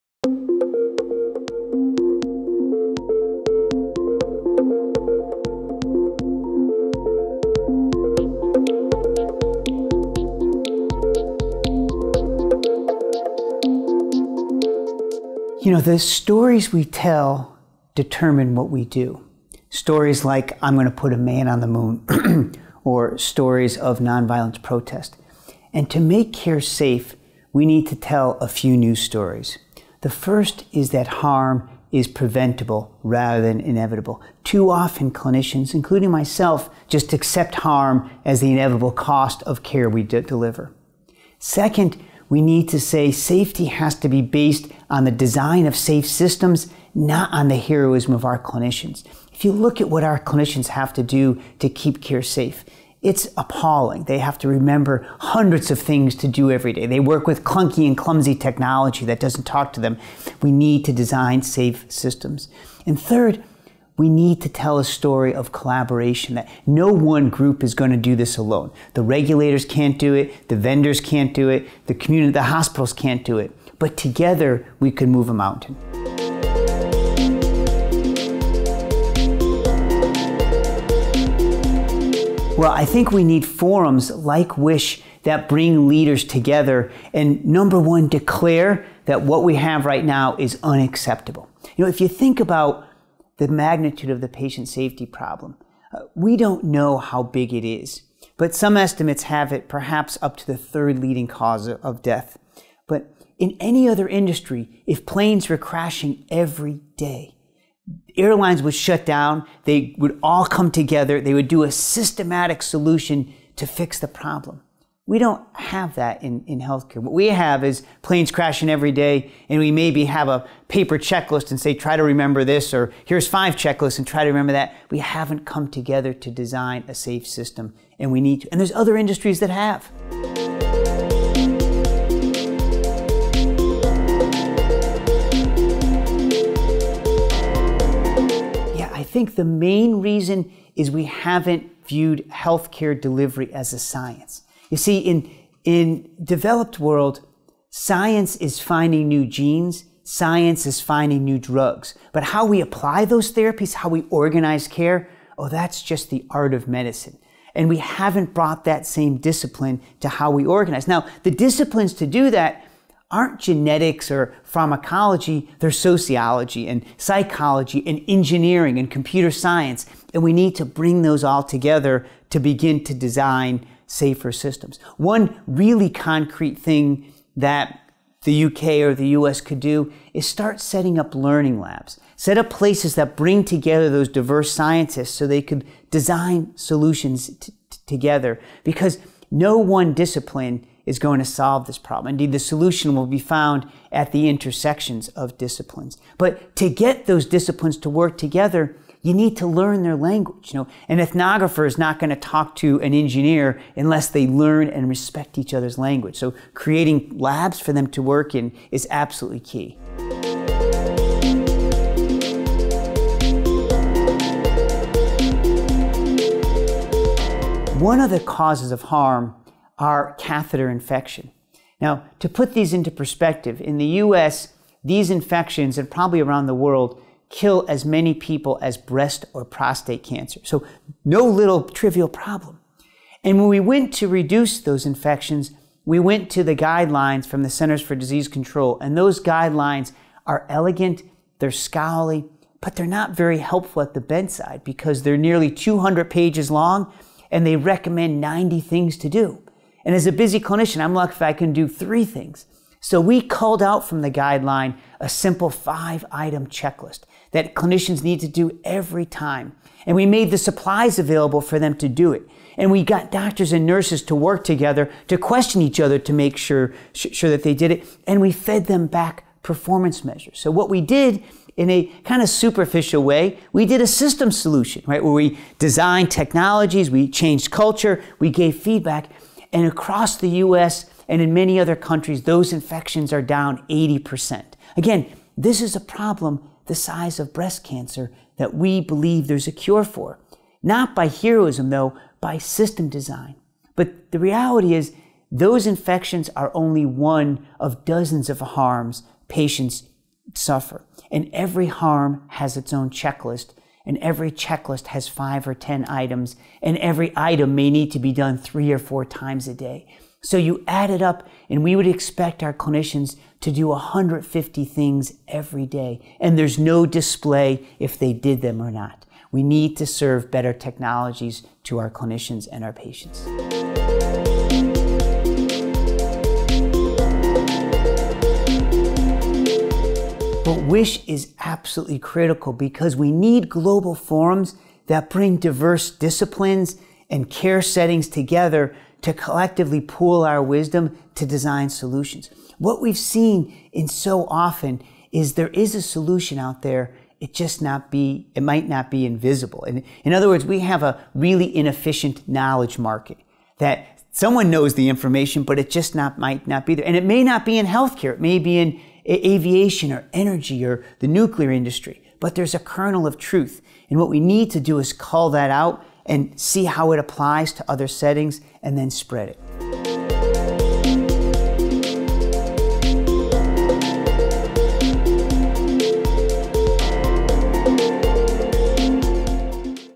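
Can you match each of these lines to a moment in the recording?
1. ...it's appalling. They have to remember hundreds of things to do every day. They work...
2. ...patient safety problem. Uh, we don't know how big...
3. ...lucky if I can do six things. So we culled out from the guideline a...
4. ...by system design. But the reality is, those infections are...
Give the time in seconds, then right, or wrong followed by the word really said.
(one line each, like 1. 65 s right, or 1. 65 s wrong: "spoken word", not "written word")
1. 53 s right
2. 94 s right
3. 250 s wrong: "three", not "six"
4. 292 s right.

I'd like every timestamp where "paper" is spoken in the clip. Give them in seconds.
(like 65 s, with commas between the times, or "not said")
120 s.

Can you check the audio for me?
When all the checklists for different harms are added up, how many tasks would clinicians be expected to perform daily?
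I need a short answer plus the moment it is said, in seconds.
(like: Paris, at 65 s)
150, at 313 s.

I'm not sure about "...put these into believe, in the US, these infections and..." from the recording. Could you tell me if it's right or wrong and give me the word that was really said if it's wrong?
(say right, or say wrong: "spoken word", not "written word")
wrong: "perspective", not "believe".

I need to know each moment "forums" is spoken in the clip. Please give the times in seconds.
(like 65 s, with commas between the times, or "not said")
83 s, 333 s.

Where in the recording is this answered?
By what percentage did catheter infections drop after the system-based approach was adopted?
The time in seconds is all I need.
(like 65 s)
283 s.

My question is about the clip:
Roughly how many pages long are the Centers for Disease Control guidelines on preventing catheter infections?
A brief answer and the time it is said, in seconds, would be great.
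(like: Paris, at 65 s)
200, at 245 s.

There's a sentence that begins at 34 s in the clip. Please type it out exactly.
Too often, clinicians, including myself, just accept harm as the inevitable cost of care we deliver.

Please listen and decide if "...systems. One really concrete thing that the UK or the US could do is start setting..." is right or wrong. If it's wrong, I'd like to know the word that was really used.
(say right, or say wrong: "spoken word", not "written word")
right.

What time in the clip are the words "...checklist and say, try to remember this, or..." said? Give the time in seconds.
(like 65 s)
120 s.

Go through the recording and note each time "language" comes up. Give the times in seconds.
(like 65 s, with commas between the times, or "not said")
199 s, 205 s.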